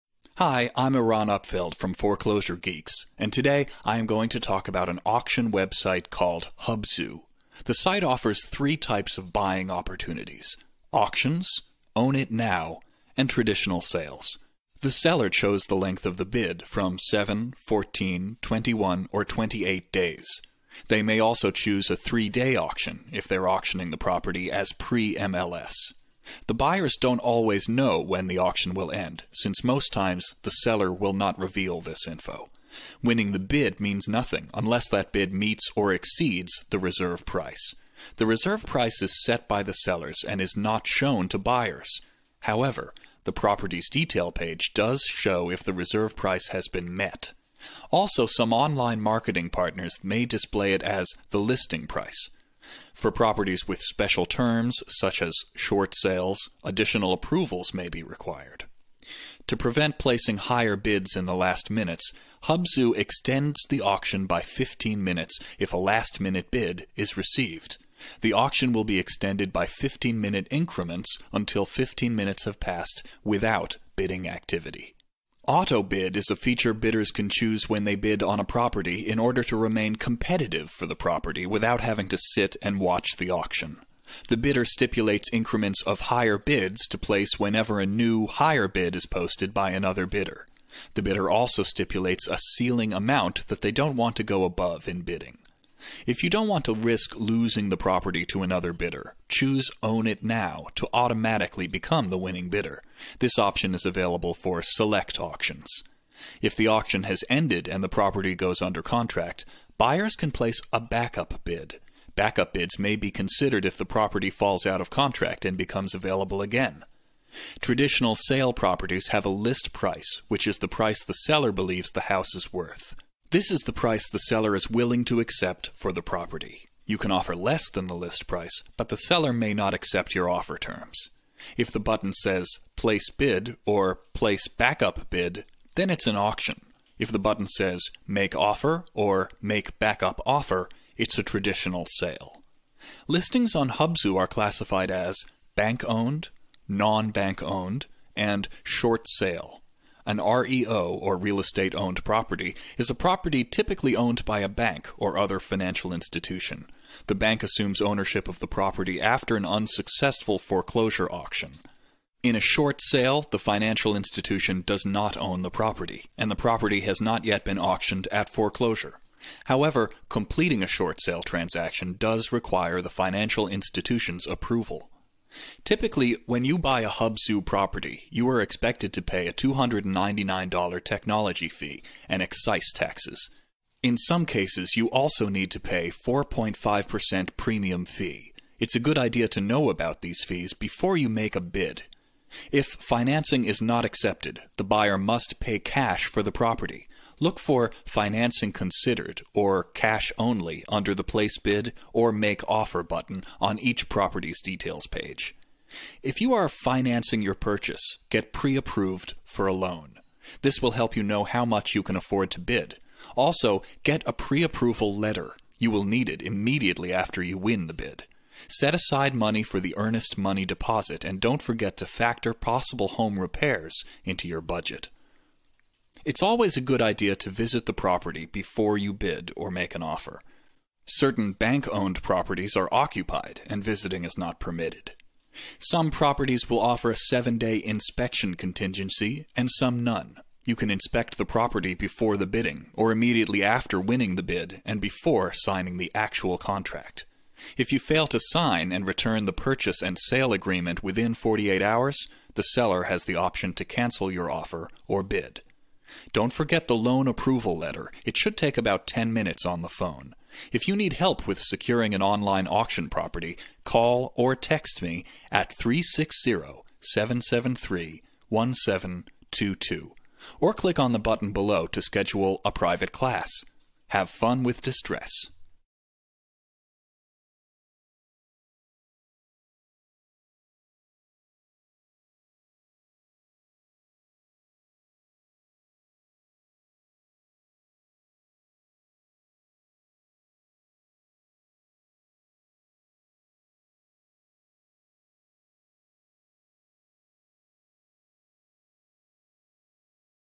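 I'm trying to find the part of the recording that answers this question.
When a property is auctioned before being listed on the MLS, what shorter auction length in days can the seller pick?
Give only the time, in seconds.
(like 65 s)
21 s.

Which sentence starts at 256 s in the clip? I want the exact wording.
Don't forget the loan approval letter.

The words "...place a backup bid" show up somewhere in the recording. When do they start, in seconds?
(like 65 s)
110 s.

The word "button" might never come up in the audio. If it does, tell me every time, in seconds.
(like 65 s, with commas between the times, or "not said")
131 s, 137 s, 202 s, 270 s.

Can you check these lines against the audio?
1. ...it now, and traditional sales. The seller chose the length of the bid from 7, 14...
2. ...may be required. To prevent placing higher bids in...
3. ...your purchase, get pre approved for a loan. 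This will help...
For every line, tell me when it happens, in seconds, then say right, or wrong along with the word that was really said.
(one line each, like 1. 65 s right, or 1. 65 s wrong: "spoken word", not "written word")
1. 12 s right
2. 57 s right
3. 207 s right.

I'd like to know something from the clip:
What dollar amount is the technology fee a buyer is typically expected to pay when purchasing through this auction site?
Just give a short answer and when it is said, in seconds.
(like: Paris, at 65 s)
$299, at 179 s.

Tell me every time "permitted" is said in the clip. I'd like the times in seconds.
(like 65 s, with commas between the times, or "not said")
234 s.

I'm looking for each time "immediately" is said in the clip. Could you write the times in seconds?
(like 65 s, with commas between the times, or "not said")
216 s, 242 s.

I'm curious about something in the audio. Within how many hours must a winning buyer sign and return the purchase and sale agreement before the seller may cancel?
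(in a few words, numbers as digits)
48 hours.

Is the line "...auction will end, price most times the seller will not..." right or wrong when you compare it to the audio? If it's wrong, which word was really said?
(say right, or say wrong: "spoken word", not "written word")
wrong: "since", not "price".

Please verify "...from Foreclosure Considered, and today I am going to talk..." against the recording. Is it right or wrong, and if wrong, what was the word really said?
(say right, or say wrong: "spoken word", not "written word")
wrong: "Geeks", not "Considered".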